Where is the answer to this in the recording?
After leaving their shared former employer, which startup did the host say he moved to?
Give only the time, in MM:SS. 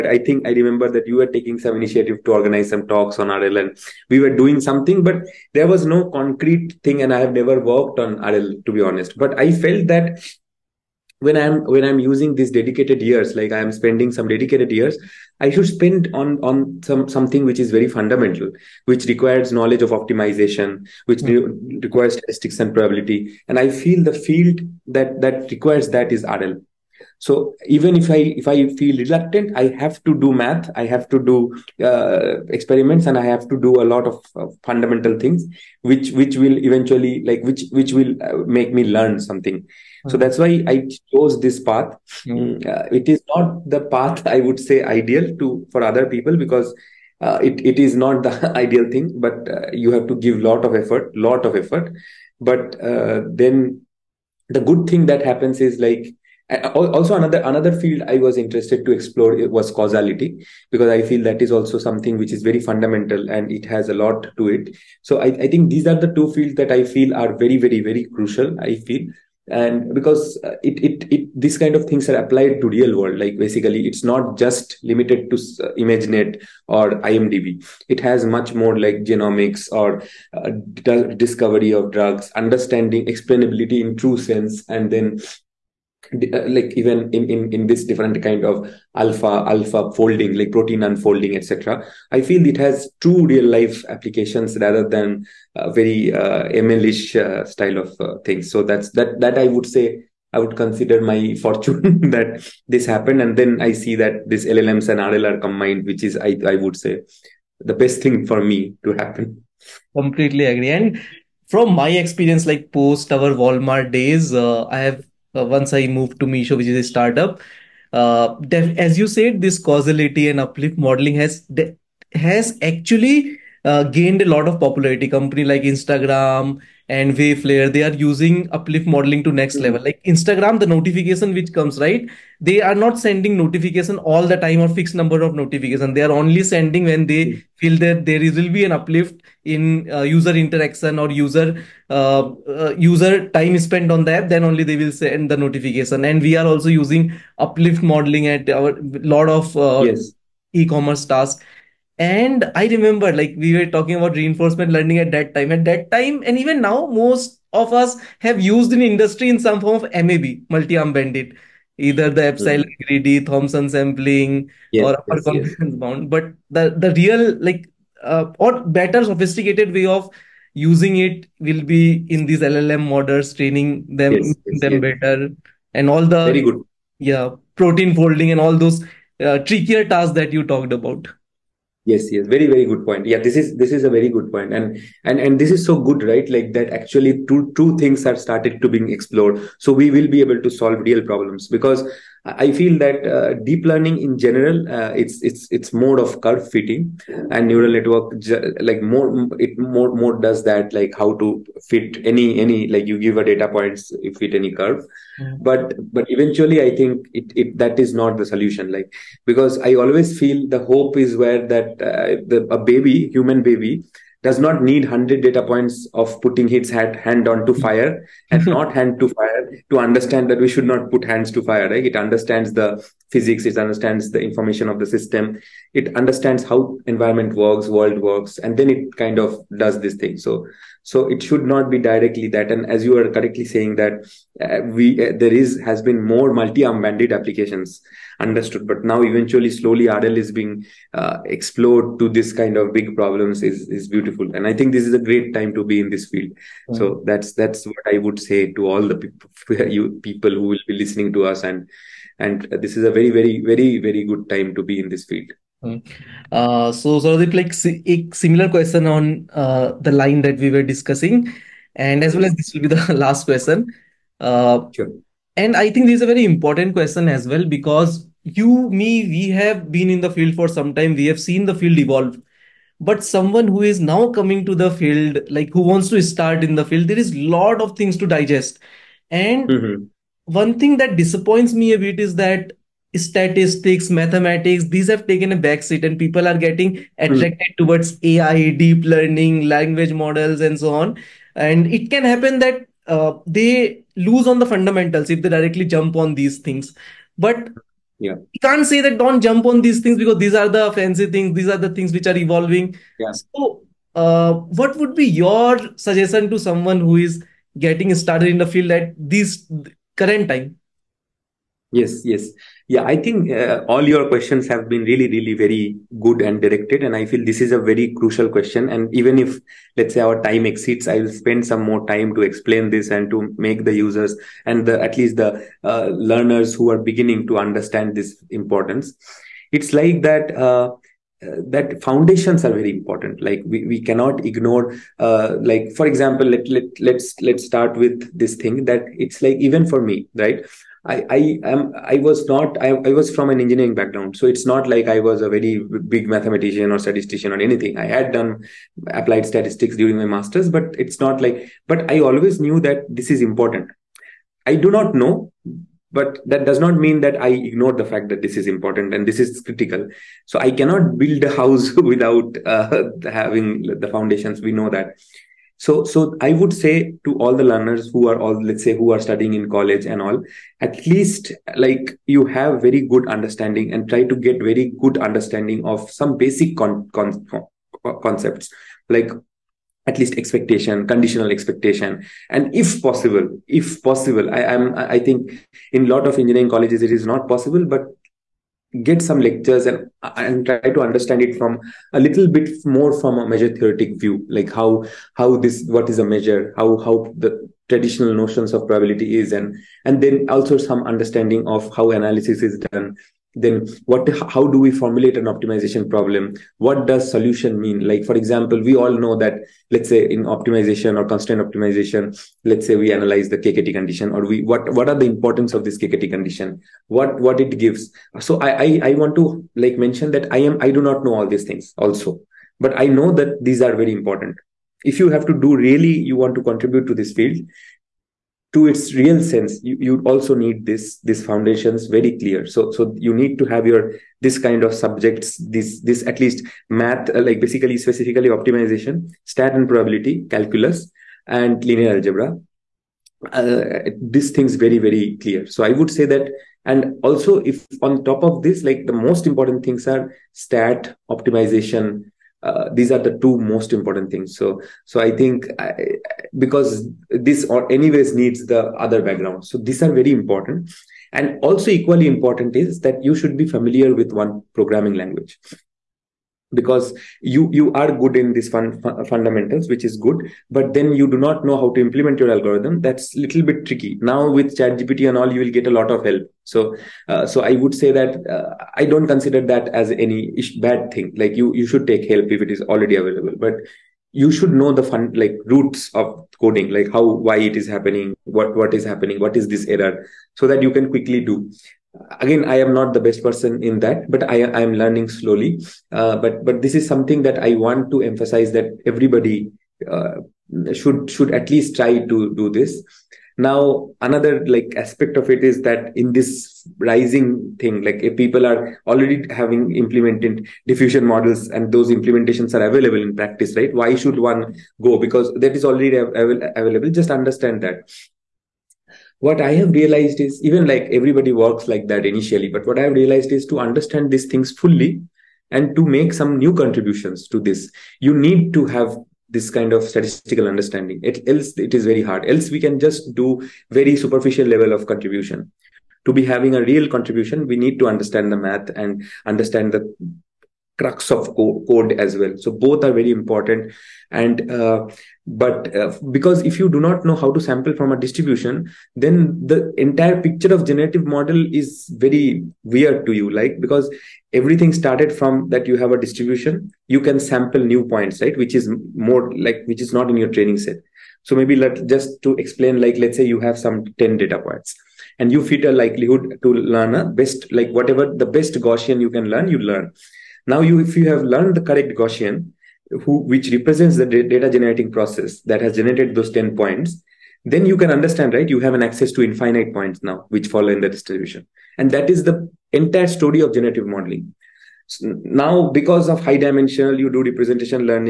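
01:56.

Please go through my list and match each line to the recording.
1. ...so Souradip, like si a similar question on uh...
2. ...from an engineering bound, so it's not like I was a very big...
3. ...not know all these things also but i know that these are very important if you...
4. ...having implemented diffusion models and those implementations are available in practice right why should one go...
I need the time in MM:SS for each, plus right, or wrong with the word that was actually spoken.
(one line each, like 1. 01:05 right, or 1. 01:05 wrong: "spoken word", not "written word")
1. 04:16 right
2. 05:43 wrong: "background", not "bound"
3. 07:00 right
4. 08:29 right.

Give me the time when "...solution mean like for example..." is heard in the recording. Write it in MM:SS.
06:47.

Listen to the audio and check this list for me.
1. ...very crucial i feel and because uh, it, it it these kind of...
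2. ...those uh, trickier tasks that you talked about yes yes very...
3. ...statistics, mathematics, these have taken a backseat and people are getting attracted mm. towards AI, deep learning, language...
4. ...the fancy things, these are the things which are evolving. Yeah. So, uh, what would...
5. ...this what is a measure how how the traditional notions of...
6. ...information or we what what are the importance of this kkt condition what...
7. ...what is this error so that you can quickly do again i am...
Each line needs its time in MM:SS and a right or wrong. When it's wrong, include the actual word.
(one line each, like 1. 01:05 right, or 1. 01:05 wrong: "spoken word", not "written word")
1. 01:07 right
2. 02:58 right
3. 04:42 right
4. 05:00 right
5. 06:35 right
6. 06:53 wrong: "condition", not "information"
7. 08:09 right.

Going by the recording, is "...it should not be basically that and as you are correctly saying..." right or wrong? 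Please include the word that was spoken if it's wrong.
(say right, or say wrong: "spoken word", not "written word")
wrong: "directly", not "basically".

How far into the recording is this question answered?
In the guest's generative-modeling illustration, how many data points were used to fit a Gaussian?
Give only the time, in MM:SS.
09:23.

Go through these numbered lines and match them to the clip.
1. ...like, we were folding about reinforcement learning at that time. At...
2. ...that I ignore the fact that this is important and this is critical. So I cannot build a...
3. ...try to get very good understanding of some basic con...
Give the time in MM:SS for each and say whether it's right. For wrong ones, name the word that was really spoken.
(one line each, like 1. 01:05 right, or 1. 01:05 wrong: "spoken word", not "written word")
1. 02:33 wrong: "talking", not "folding"
2. 05:57 right
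3. 06:13 right.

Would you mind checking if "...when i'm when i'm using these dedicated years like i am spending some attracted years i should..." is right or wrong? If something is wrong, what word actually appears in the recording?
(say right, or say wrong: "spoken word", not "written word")
wrong: "dedicated", not "attracted".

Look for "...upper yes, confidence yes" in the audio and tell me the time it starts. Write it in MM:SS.
02:44.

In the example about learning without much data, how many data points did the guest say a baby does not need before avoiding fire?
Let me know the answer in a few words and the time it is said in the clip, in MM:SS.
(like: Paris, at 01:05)
100, at 03:34.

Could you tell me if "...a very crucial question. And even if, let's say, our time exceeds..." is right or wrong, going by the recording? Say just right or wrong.
right.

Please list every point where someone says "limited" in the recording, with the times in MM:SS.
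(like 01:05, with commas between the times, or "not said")
01:14.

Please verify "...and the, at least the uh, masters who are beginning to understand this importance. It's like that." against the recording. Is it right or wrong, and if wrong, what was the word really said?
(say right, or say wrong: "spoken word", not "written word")
wrong: "learners", not "masters".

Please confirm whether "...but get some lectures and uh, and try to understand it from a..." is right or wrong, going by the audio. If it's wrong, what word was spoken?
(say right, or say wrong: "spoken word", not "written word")
right.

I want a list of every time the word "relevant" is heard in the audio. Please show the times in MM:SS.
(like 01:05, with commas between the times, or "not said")
not said.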